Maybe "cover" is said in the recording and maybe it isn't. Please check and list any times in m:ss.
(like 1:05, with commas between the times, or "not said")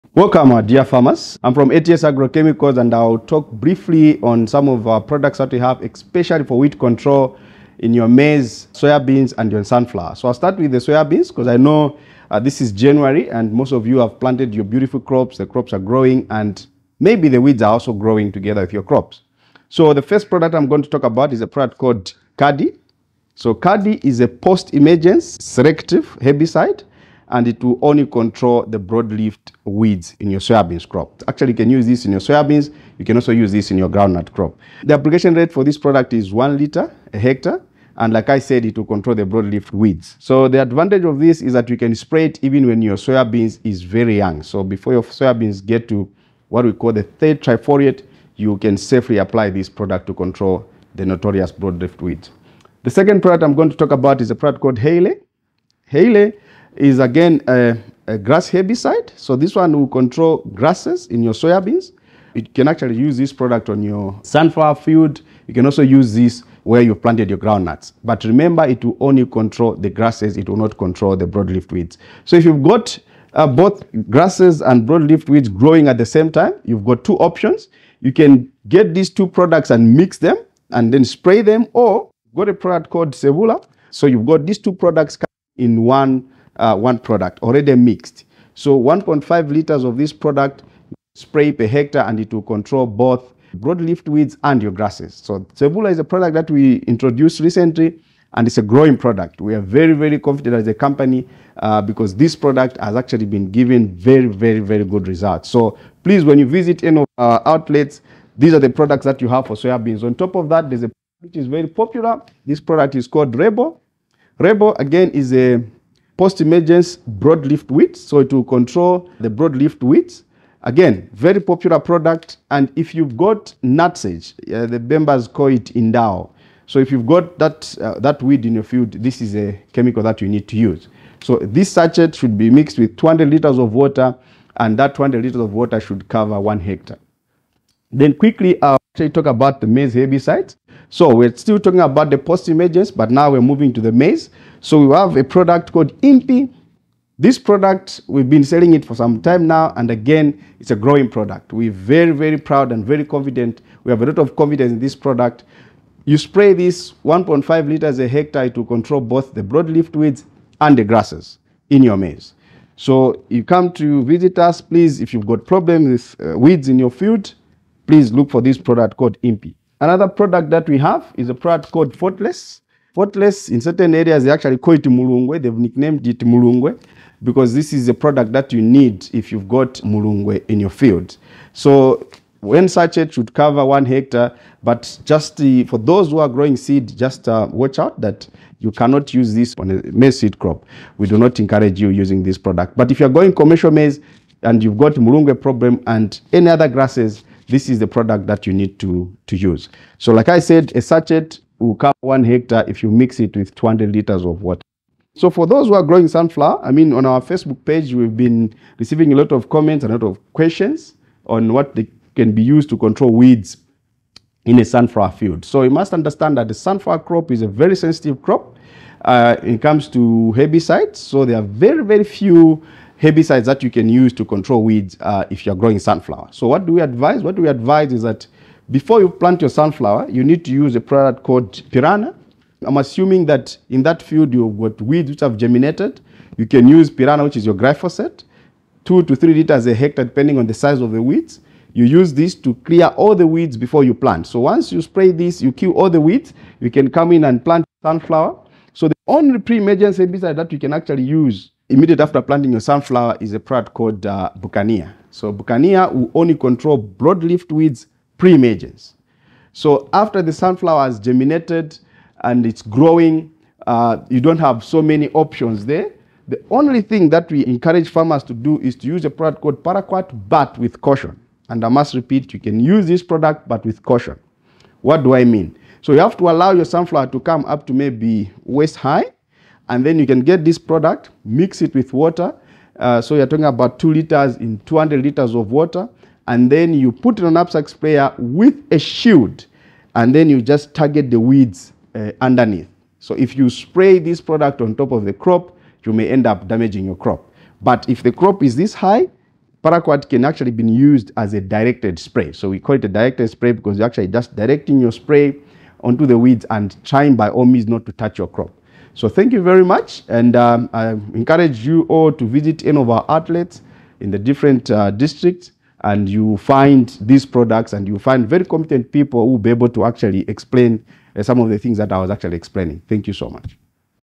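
2:16, 3:03, 3:21.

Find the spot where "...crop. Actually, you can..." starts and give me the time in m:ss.
0:30.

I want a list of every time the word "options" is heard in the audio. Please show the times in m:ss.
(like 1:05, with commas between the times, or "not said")
1:17, 4:25.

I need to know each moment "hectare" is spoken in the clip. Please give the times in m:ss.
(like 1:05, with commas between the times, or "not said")
0:37, 1:31, 2:16, 2:38, 3:03, 3:22, 3:59.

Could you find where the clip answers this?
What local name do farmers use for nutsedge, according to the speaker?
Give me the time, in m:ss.
2:05.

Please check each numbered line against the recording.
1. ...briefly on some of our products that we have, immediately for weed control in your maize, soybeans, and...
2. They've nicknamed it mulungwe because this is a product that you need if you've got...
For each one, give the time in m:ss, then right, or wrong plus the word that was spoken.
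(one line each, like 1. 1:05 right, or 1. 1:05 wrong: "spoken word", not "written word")
1. 0:03 wrong: "especially", not "immediately"
2. 2:55 right.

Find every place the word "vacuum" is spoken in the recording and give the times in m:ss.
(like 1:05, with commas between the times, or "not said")
not said.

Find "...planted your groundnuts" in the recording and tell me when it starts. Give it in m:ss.
1:06.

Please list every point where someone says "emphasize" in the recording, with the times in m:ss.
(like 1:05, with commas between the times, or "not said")
not said.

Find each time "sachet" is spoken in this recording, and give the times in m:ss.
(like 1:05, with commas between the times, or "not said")
2:11, 3:02, 3:20.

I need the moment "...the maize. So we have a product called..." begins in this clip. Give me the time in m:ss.
2:23.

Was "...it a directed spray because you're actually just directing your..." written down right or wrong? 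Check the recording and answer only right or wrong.
right.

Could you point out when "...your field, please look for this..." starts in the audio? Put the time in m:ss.
2:46.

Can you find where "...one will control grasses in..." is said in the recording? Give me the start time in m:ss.
0:59.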